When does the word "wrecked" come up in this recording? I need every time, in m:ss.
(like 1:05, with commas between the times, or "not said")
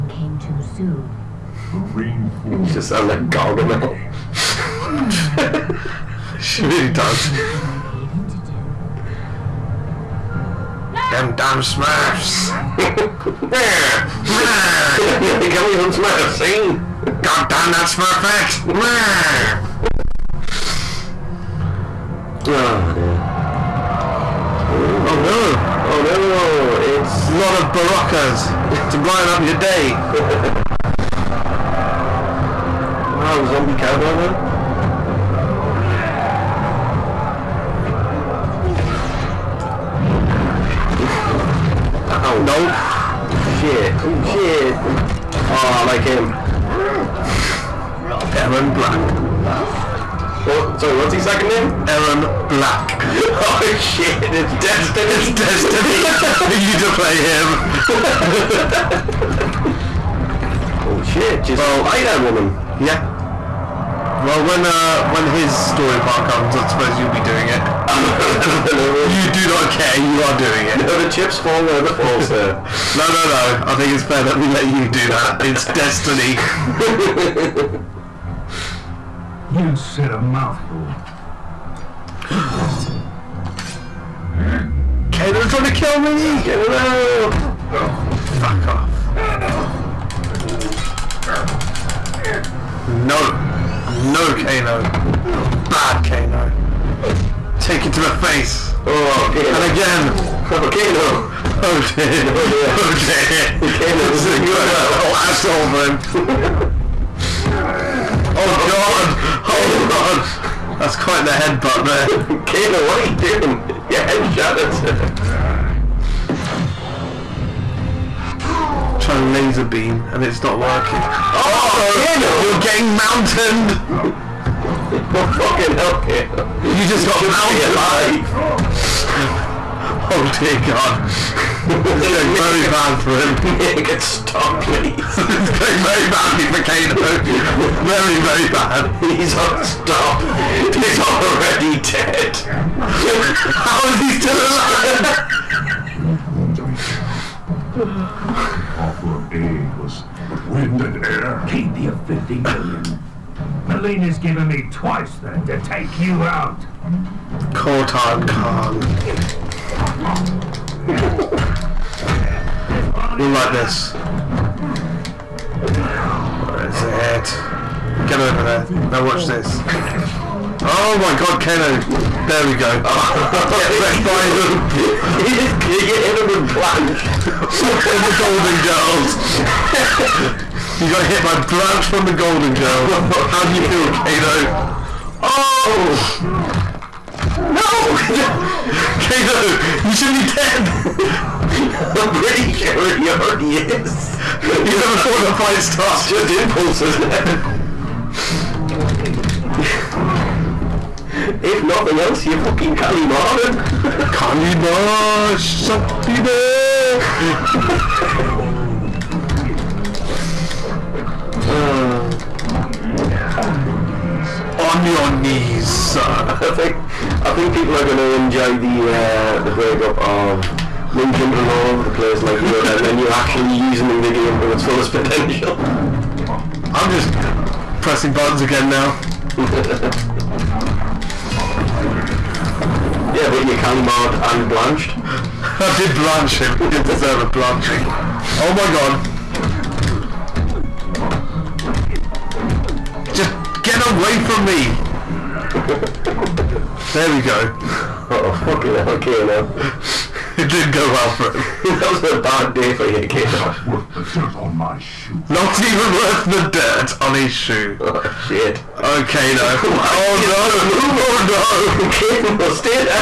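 2:53.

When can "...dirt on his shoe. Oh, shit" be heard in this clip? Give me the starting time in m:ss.
4:16.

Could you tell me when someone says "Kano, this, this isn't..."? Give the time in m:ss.
1:43.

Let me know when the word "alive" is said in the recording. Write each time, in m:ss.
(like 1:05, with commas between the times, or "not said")
2:07, 2:24.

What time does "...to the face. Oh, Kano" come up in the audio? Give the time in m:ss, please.
1:37.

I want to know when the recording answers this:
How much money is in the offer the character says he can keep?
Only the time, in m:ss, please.
2:32.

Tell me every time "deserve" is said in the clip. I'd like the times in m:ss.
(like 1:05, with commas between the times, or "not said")
3:56.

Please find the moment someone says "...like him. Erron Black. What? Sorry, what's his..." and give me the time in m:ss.
0:45.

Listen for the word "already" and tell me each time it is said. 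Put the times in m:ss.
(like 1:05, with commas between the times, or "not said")
2:20, 3:13.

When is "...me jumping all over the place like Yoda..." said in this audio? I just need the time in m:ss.
3:40.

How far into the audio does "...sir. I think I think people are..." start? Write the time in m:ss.
3:35.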